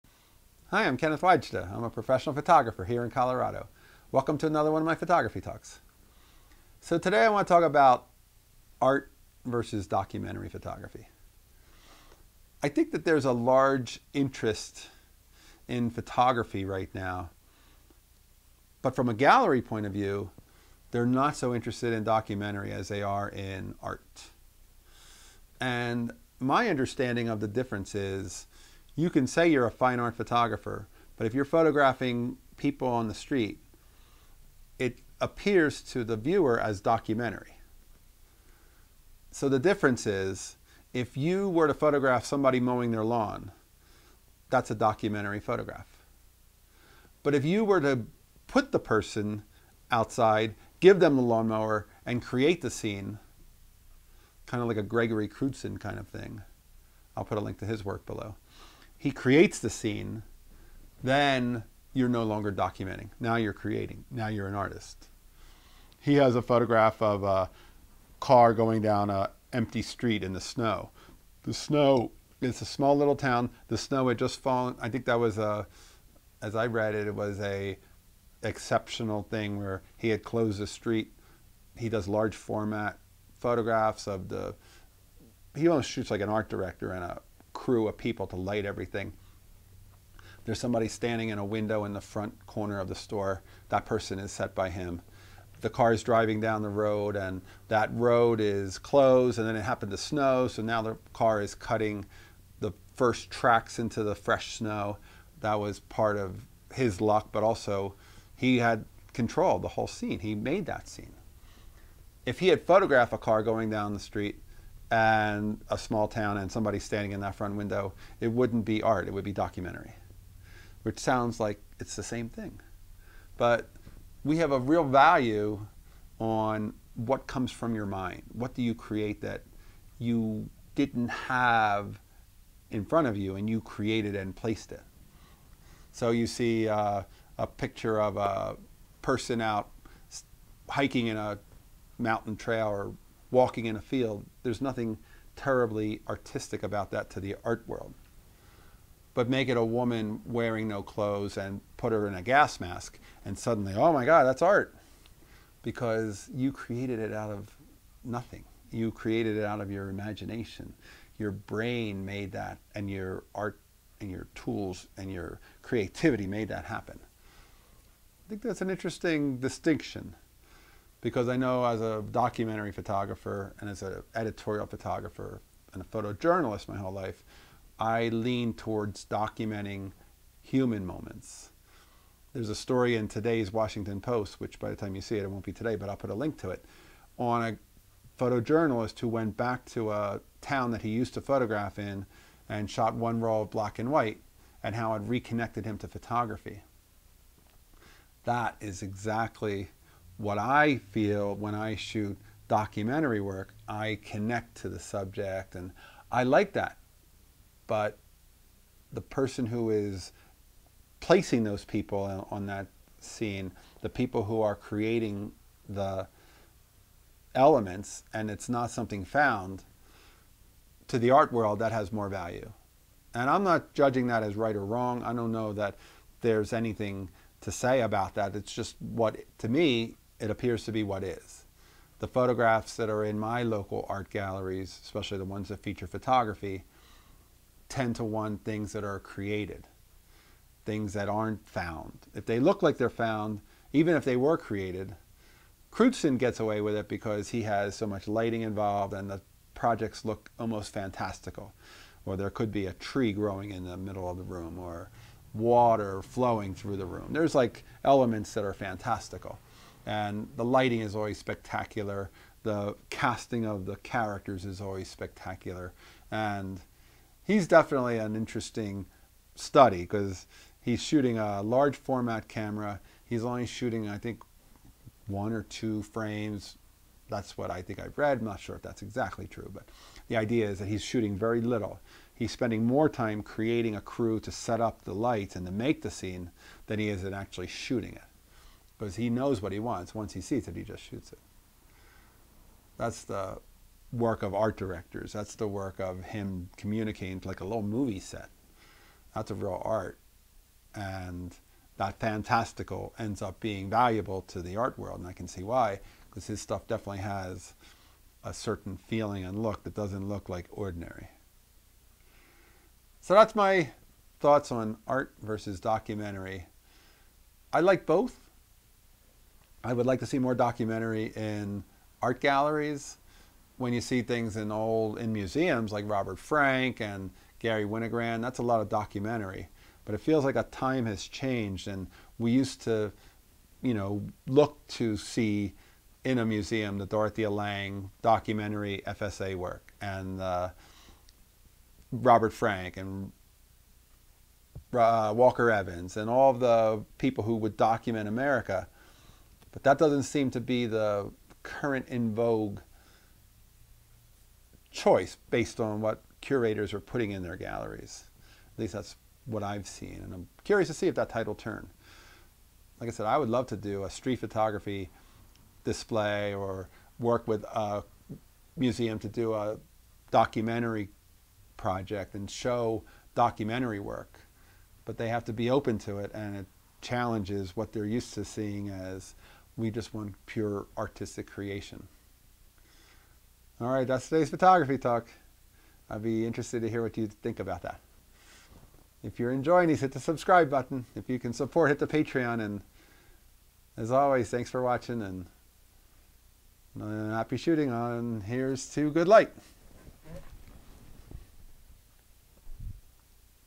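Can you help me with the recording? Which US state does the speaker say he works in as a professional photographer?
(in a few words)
Colorado.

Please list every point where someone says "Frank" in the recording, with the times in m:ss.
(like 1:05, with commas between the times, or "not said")
5:26, 5:42.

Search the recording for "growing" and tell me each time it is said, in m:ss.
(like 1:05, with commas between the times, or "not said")
4:13.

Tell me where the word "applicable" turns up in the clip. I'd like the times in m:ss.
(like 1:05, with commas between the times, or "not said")
not said.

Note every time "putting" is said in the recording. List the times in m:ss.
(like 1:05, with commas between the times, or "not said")
5:56.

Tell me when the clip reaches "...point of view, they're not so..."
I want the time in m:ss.
0:19.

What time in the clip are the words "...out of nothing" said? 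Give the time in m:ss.
2:37.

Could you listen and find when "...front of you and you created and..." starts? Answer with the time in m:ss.
2:12.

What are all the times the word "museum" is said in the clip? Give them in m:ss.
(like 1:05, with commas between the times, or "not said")
5:25, 5:36, 6:08.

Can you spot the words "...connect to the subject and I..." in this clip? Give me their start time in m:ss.
3:24.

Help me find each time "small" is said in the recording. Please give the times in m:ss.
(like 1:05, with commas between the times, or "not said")
1:12, 1:55.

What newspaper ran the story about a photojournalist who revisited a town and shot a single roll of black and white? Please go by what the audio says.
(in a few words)
Washington Post.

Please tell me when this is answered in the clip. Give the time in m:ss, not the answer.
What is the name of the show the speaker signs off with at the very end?
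6:38.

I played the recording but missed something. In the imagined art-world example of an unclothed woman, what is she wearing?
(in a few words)
a gas mask.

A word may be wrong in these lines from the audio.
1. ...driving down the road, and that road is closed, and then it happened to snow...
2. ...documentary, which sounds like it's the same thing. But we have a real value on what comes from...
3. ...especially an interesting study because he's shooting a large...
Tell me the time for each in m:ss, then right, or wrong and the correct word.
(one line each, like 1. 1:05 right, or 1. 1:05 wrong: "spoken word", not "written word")
1. 1:36 right
2. 1:59 right
3. 4:27 wrong: "definitely", not "especially".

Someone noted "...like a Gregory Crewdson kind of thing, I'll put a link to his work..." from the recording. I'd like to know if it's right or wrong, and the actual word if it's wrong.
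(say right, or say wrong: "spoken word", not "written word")
right.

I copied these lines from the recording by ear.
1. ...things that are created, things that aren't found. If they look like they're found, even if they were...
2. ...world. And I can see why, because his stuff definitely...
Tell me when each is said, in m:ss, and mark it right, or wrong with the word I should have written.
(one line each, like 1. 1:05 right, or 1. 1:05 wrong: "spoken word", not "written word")
1. 3:58 right
2. 5:04 right.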